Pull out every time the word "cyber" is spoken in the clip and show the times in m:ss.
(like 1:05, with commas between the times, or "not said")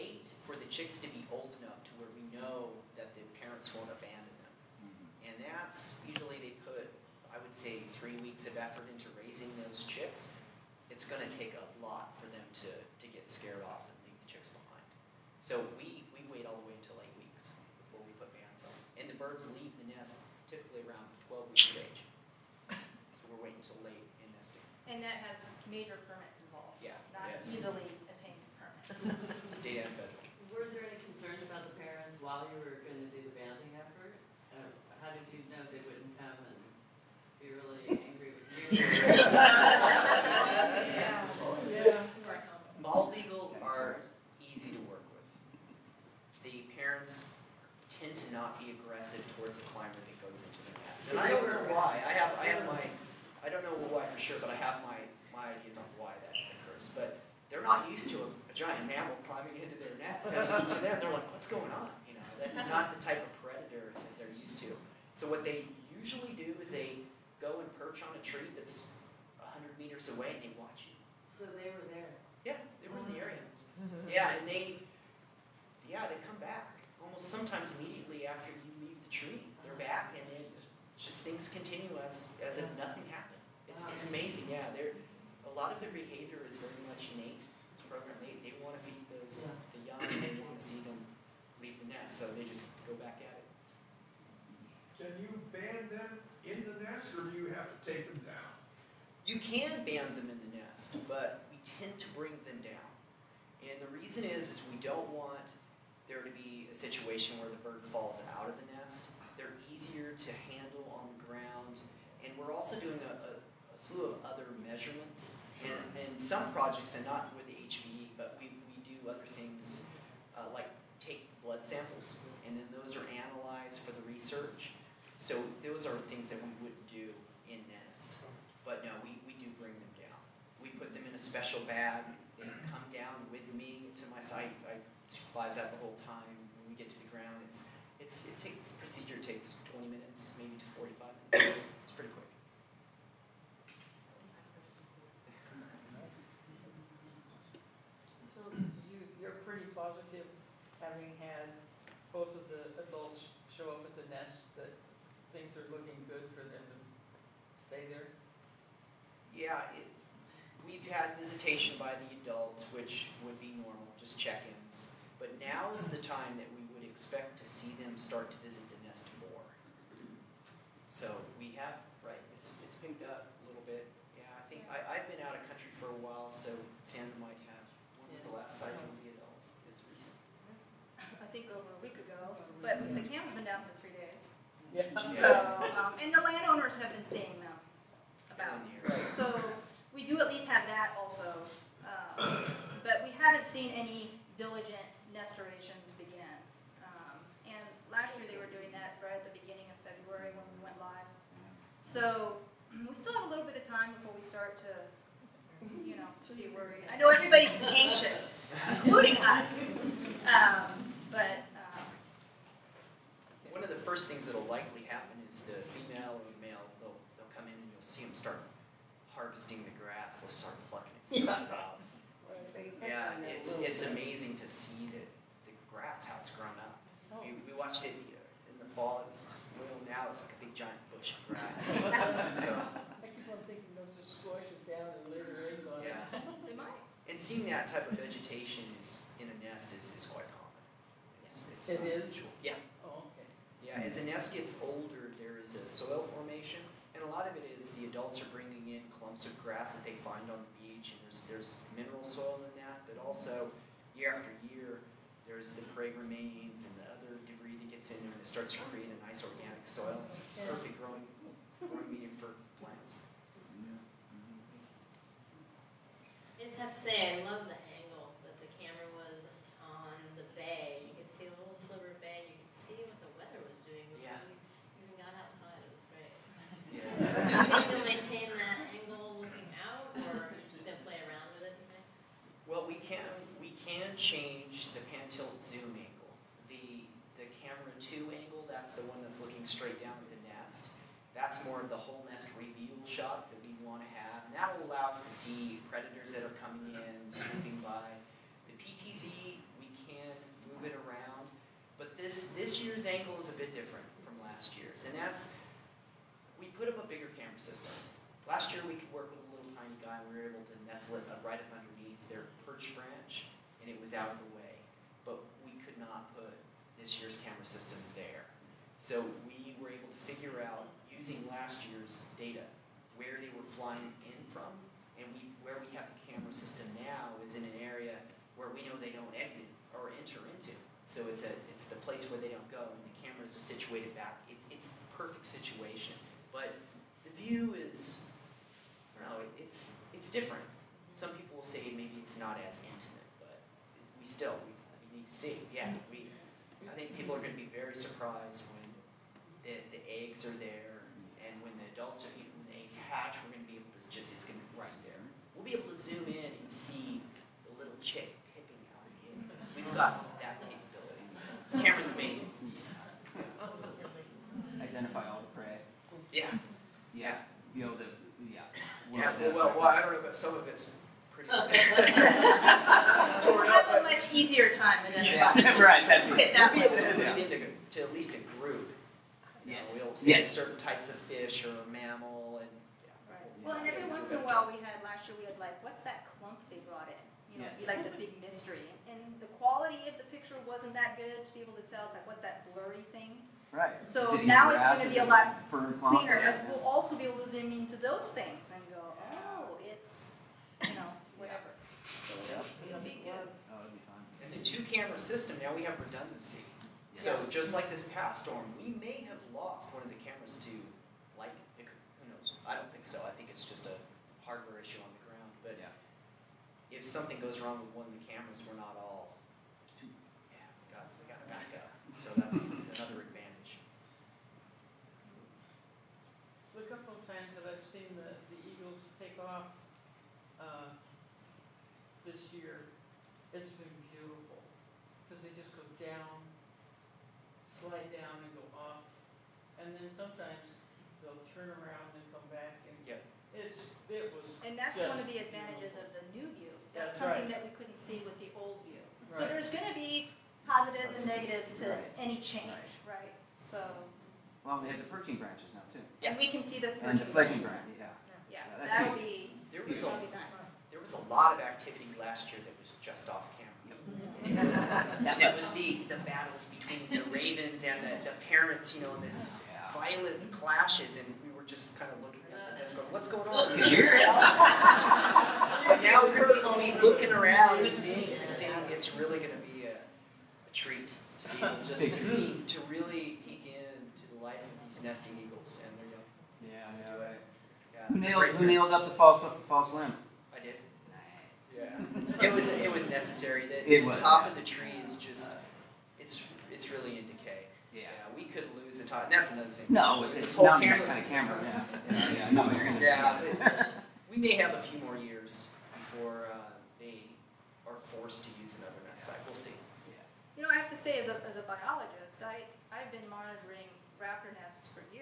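not said.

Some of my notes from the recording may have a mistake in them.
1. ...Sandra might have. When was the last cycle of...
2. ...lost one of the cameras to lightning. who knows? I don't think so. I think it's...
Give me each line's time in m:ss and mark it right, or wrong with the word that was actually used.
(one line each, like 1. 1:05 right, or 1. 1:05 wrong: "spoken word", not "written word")
1. 2:56 right
2. 6:49 right.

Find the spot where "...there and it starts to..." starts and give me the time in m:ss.
4:18.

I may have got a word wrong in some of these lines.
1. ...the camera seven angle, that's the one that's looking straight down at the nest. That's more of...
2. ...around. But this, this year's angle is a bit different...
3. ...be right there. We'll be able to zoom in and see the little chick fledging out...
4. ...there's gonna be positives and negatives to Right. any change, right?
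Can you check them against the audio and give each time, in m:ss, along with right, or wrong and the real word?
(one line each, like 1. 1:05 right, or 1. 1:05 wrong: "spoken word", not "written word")
1. 4:47 wrong: "two", not "seven"
2. 5:00 right
3. 5:54 wrong: "pipping", not "fledging"
4. 7:29 right.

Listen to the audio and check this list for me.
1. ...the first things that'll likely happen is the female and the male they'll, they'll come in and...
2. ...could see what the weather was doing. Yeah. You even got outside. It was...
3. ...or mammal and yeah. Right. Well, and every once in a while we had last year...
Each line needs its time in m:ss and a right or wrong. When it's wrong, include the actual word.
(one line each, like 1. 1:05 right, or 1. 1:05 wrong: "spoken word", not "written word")
1. 3:33 right
2. 4:32 right
3. 6:21 right.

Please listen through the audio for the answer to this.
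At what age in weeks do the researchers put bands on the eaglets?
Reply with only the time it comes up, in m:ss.
0:17.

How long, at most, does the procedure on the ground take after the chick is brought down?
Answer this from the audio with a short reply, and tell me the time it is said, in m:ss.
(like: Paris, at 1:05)
45 minutes, at 2:20.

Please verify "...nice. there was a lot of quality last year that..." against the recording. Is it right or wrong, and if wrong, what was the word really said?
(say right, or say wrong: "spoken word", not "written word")
wrong: "activity", not "quality".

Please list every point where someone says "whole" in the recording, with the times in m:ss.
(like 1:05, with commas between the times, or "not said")
2:15, 4:51, 8:20.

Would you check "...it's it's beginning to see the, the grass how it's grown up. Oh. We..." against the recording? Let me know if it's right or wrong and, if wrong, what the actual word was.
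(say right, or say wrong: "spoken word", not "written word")
wrong: "amazing", not "beginning".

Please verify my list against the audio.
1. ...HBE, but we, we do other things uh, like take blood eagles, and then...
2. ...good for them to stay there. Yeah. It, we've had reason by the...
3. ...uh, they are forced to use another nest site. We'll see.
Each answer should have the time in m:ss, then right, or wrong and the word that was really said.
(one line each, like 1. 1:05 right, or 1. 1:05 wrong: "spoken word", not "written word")
1. 1:57 wrong: "samples", not "eagles"
2. 2:36 wrong: "visitation", not "reason"
3. 8:26 right.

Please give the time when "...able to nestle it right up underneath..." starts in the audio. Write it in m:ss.
5:10.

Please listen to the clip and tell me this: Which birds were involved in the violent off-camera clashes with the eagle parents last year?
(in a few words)
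Ravens.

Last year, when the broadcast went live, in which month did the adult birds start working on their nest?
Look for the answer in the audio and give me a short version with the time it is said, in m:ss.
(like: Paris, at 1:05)
February, at 3:19.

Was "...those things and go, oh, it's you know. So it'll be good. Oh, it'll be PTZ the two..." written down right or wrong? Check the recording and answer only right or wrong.
wrong.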